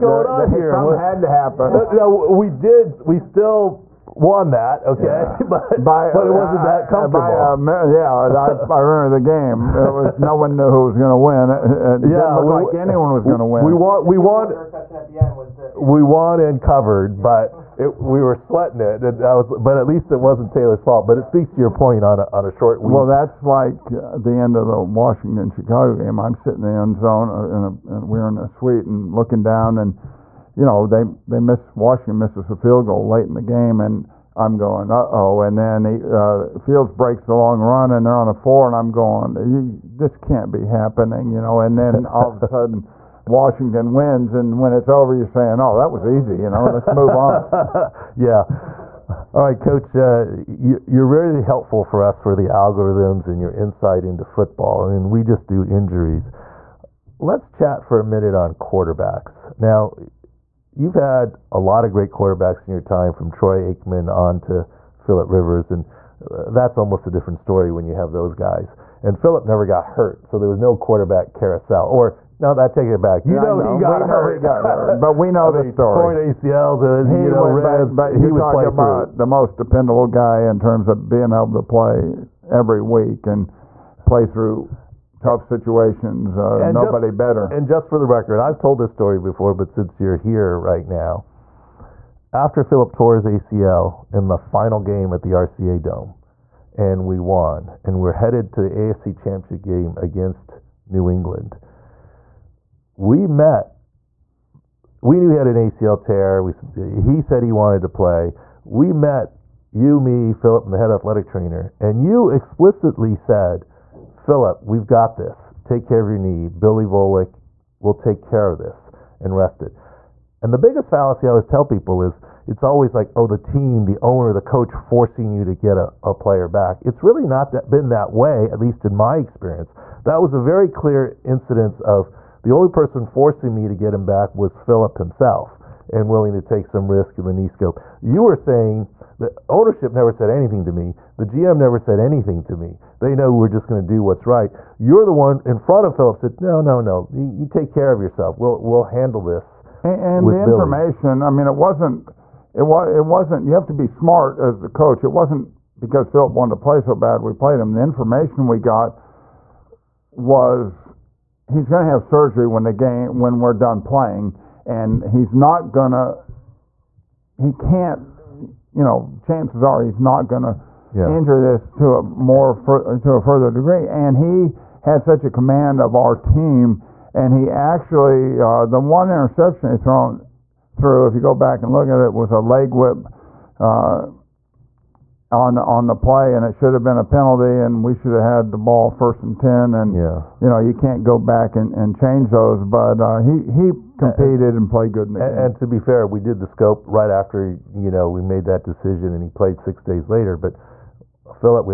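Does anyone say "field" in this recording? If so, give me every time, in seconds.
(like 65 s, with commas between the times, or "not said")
32 s, 36 s.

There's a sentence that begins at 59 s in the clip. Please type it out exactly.
Now, you've had a lot of great quarterbacks in your time from Troy Aikman on to Philip Rivers.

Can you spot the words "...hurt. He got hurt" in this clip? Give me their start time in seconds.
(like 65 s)
74 s.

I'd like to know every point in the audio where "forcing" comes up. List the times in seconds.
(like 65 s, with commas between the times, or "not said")
124 s, 133 s.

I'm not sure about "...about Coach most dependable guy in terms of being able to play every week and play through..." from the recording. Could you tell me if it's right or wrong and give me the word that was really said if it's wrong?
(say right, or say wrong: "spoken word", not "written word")
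wrong: "The", not "Coach".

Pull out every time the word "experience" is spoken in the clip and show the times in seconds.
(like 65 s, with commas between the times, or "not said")
129 s.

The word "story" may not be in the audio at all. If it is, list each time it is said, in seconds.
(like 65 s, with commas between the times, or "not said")
67 s, 75 s, 88 s.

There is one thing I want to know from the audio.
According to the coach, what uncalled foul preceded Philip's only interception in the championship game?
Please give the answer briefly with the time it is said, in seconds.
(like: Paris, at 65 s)
Leg whip, at 182 s.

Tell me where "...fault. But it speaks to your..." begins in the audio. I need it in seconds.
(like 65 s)
20 s.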